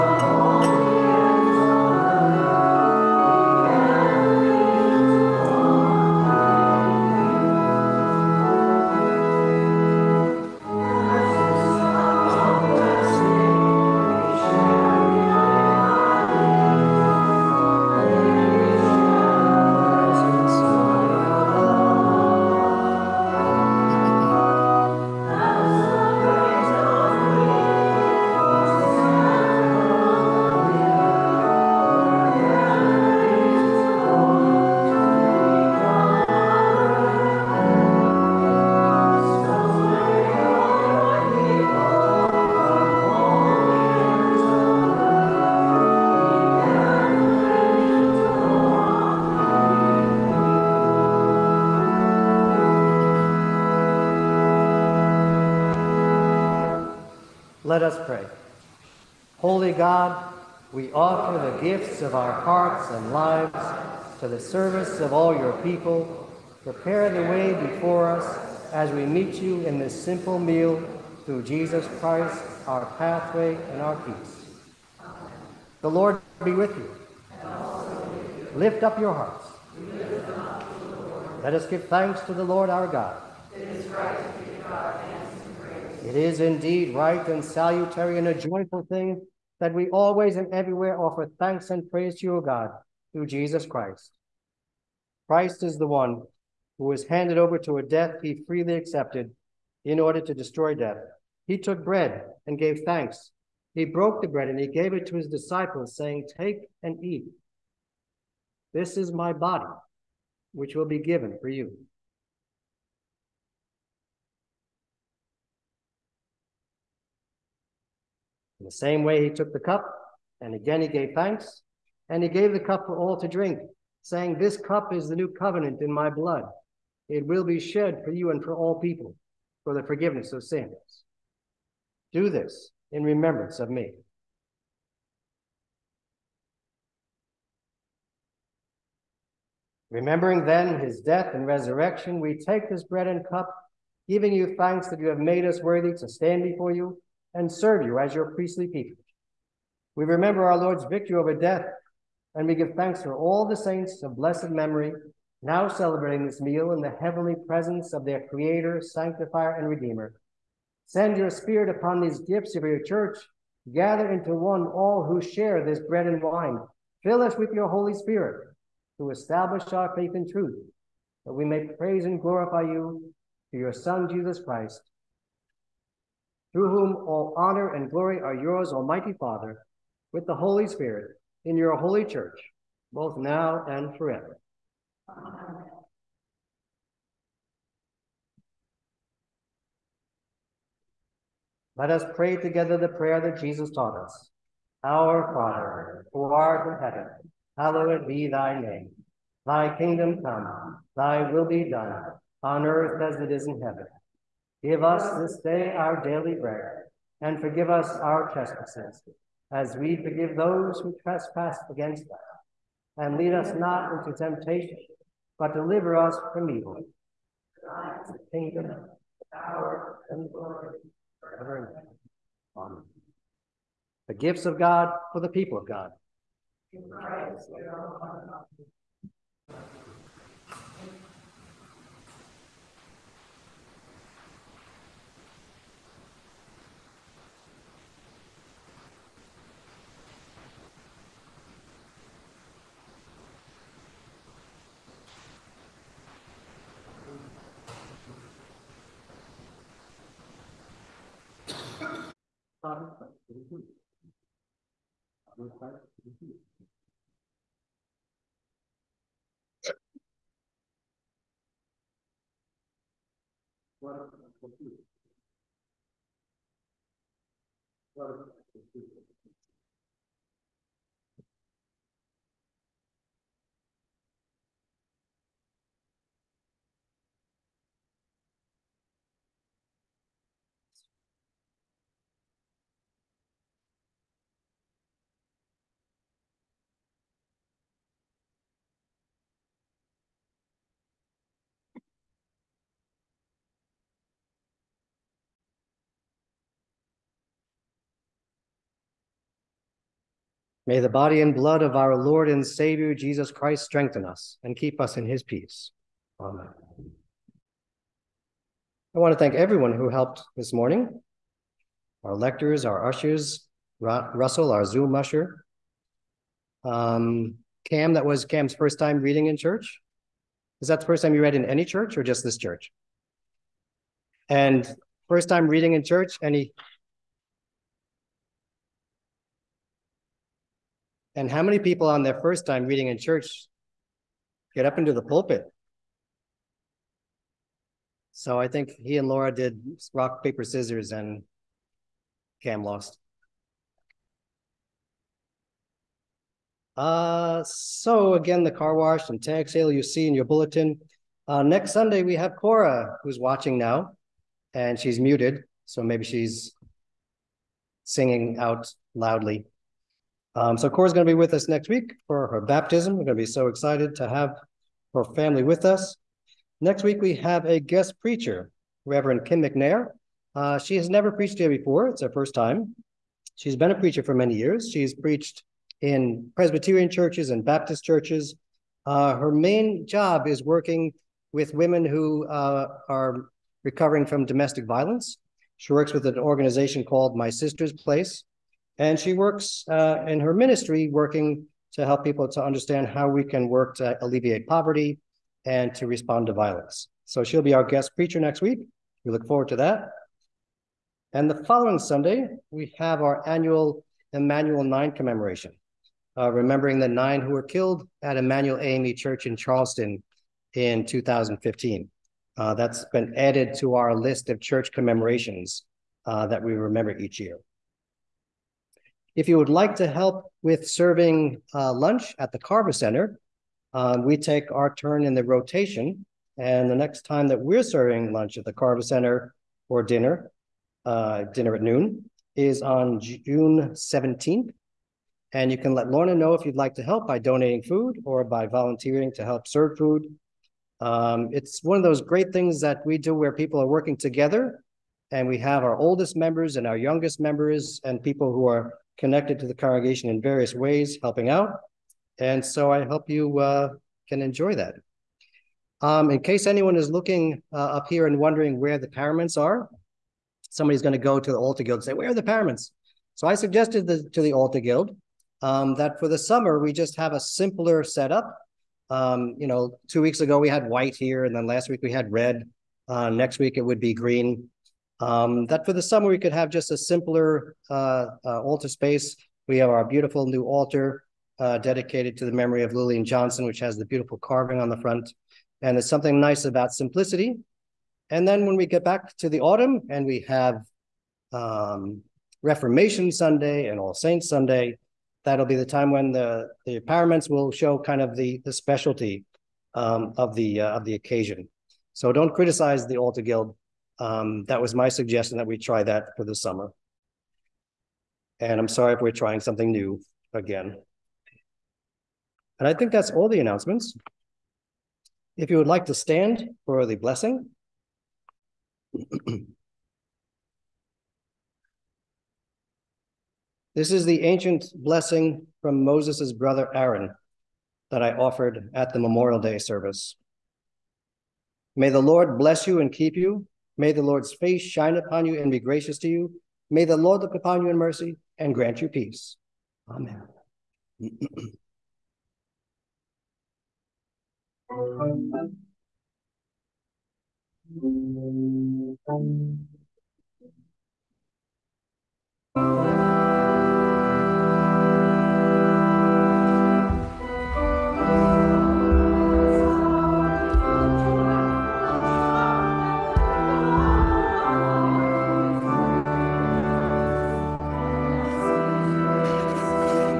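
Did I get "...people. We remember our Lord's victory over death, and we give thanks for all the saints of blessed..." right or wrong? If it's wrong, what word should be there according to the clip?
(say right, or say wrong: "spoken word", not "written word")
right.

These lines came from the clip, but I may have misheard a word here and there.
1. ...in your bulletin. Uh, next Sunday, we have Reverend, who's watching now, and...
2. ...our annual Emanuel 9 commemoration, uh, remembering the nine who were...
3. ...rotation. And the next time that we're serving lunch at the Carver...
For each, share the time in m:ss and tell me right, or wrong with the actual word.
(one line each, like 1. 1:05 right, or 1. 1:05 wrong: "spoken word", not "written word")
1. 5:50 wrong: "Cora", not "Reverend"
2. 6:43 right
3. 7:05 right.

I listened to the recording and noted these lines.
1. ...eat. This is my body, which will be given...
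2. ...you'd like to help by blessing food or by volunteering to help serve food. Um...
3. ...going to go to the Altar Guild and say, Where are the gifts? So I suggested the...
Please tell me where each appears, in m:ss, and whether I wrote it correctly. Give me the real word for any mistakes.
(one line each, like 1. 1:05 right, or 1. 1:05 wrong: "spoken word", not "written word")
1. 1:47 right
2. 7:16 wrong: "donating", not "blessing"
3. 7:40 wrong: "paraments", not "gifts".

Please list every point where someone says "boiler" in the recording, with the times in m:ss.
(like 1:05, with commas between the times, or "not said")
not said.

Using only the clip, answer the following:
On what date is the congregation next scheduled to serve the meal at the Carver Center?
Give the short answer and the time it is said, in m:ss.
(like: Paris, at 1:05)
June 17th, at 7:12.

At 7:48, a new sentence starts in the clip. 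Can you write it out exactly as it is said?
Um, you know, two weeks ago we had white here, and then last week we had red.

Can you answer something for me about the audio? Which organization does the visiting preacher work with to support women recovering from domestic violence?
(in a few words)
My Sister's Place.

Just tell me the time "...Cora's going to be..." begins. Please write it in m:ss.
6:00.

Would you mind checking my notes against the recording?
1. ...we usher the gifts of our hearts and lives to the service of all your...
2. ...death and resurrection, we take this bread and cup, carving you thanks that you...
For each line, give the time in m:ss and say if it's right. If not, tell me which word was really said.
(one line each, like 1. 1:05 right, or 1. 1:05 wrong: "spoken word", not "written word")
1. 1:00 wrong: "offer", not "usher"
2. 2:21 wrong: "giving", not "carving".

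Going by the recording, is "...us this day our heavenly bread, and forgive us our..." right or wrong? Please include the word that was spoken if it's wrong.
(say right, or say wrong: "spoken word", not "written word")
wrong: "daily", not "heavenly".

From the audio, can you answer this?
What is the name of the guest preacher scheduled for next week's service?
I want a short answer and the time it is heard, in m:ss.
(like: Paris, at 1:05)
Reverend Kim McNair, at 6:08.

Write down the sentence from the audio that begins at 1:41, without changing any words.
He took bread and gave thanks.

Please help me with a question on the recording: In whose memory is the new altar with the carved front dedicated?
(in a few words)
Lillian Johnson.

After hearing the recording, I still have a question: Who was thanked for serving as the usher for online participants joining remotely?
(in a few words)
Russell.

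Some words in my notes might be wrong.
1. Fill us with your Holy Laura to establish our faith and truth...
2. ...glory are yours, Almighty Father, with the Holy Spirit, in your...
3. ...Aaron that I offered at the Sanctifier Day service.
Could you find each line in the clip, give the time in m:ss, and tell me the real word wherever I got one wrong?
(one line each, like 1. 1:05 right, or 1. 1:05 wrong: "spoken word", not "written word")
1. 2:47 wrong: "Spirit", not "Laura"
2. 2:57 right
3. 8:46 wrong: "Memorial", not "Sanctifier".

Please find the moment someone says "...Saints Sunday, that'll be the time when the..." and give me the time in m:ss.
8:13.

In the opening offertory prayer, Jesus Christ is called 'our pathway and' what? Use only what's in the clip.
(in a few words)
our peace.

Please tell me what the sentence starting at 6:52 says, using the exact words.
Uh, that's been added to our list of church commemorations uh, that we remember each year.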